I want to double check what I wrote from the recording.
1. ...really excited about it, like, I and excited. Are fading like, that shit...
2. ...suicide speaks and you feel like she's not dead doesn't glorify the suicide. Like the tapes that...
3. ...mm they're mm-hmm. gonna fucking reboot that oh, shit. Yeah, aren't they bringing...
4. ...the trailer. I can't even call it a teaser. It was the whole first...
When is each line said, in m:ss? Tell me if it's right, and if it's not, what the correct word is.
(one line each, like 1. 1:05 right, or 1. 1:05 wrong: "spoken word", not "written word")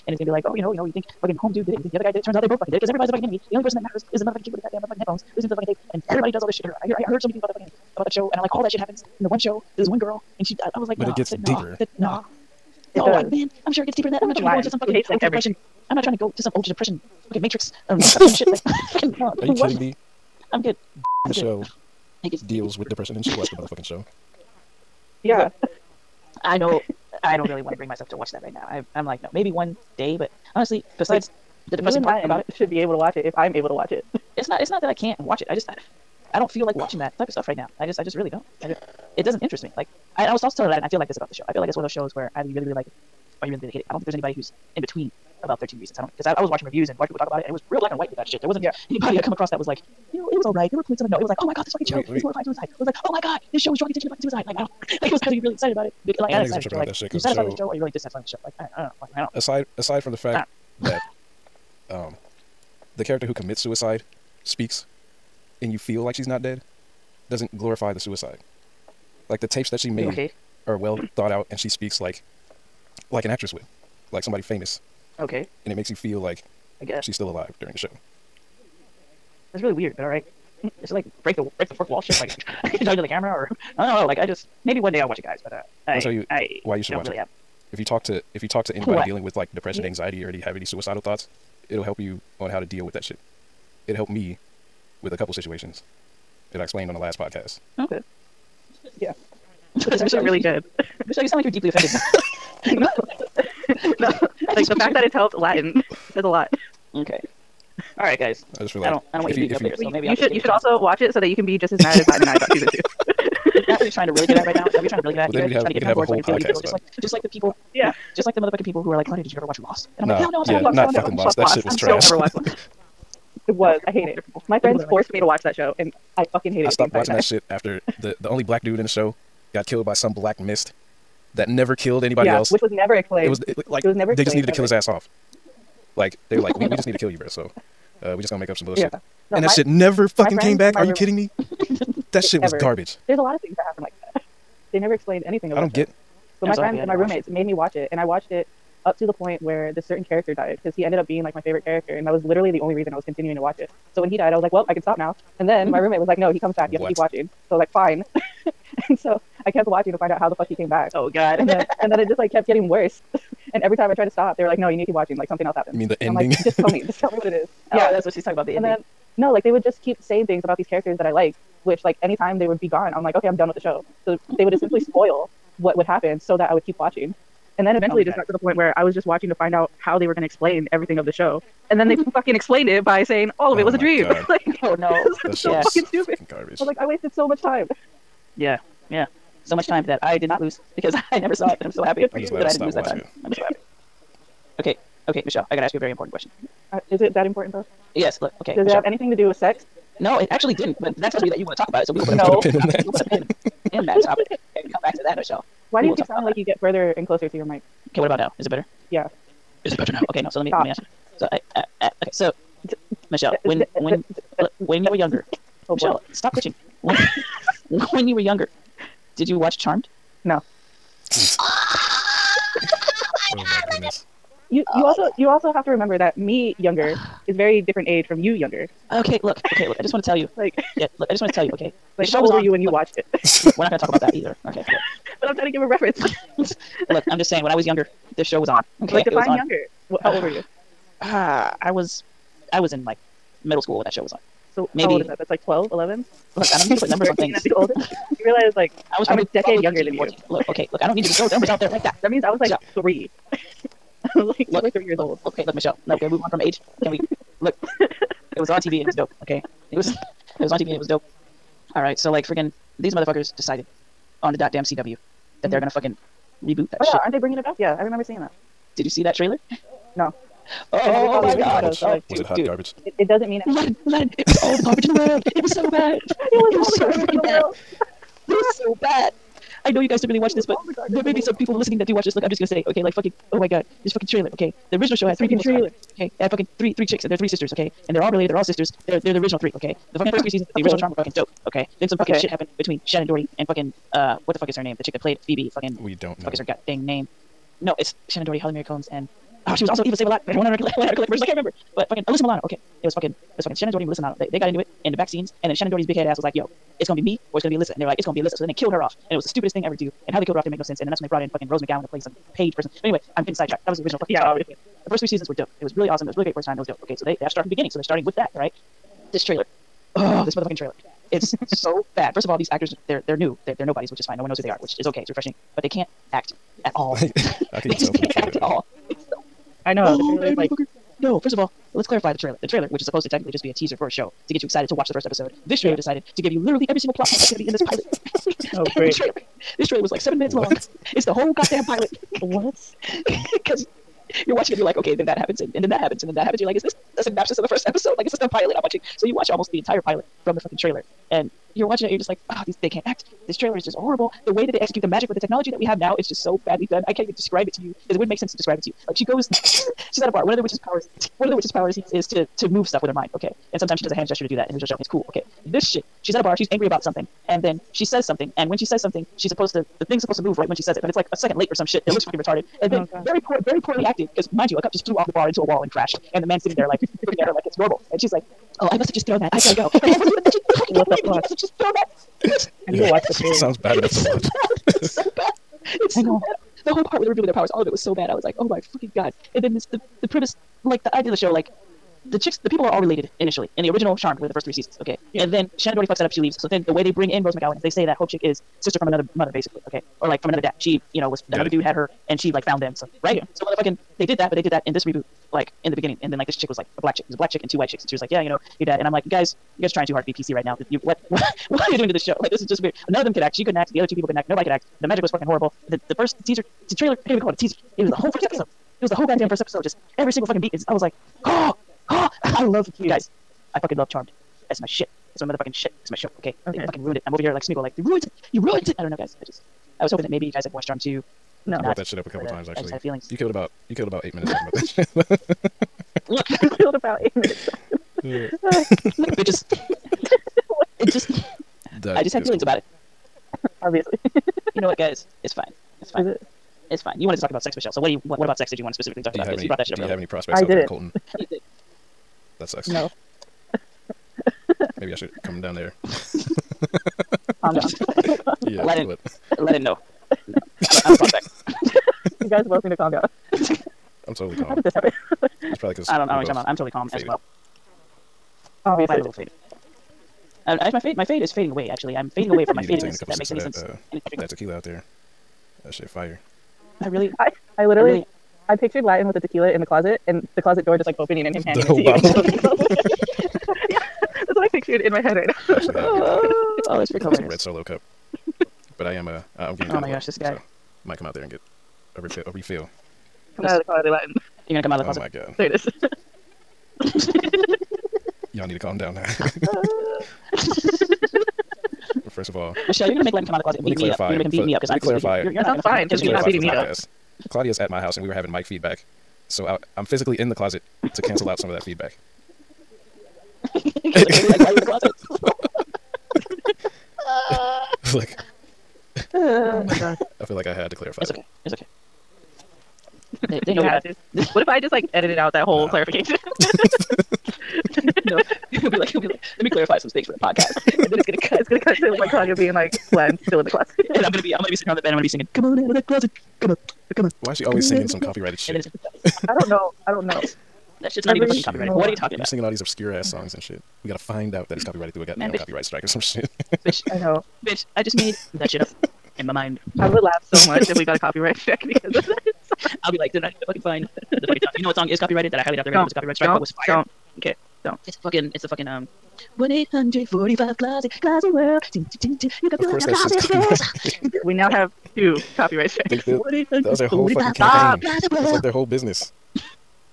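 1. 0:55 wrong: "tripping", not "fading"
2. 1:03 right
3. 4:25 right
4. 6:56 right.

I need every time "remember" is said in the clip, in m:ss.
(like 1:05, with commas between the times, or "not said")
3:45, 4:27, 5:01.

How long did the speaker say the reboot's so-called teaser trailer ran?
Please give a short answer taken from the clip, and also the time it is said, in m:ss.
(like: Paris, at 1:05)
7 minutes, at 5:40.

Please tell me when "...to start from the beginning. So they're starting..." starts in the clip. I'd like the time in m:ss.
5:17.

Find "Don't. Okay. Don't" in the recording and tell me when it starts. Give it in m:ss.
9:16.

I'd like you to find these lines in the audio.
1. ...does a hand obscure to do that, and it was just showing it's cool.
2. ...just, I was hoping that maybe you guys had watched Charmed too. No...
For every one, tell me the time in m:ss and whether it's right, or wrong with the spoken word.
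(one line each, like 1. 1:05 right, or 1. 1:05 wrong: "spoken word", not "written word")
1. 6:03 wrong: "gesture", not "obscure"
2. 7:09 right.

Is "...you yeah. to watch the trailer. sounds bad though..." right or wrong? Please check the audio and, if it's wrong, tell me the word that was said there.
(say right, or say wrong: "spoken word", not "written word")
wrong: "enough", not "though".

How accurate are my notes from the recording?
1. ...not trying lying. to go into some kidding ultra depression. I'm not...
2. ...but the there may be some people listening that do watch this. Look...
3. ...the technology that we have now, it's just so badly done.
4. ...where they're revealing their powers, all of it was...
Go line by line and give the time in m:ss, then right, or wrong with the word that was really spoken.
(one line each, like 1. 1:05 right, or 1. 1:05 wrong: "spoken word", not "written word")
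1. 0:14 wrong: "fucking", not "kidding"
2. 4:40 right
3. 5:55 right
4. 6:26 right.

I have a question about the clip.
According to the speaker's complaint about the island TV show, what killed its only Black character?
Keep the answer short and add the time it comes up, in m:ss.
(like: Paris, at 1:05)
black mist, at 2:10.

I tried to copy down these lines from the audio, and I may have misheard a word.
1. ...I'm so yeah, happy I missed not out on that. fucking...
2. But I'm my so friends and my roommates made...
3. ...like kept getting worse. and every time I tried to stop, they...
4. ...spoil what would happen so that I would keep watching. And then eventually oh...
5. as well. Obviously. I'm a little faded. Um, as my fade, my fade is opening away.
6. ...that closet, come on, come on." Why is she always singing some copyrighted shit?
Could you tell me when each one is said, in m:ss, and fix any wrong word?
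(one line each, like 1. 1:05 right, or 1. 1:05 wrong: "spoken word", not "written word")
1. 2:00 right
2. 2:26 right
3. 2:42 right
4. 2:54 right
5. 7:47 wrong: "fading", not "opening"
6. 8:55 right.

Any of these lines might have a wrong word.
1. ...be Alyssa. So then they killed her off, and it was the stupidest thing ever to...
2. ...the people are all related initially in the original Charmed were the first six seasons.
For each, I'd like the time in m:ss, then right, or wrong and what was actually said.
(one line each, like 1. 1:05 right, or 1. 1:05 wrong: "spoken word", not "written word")
1. 5:08 right
2. 6:32 wrong: "three", not "six".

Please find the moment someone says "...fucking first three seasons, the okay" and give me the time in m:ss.
4:49.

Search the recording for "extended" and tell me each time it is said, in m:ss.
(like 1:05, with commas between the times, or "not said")
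not said.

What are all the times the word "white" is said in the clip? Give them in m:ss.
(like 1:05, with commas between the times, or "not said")
0:47, 6:47.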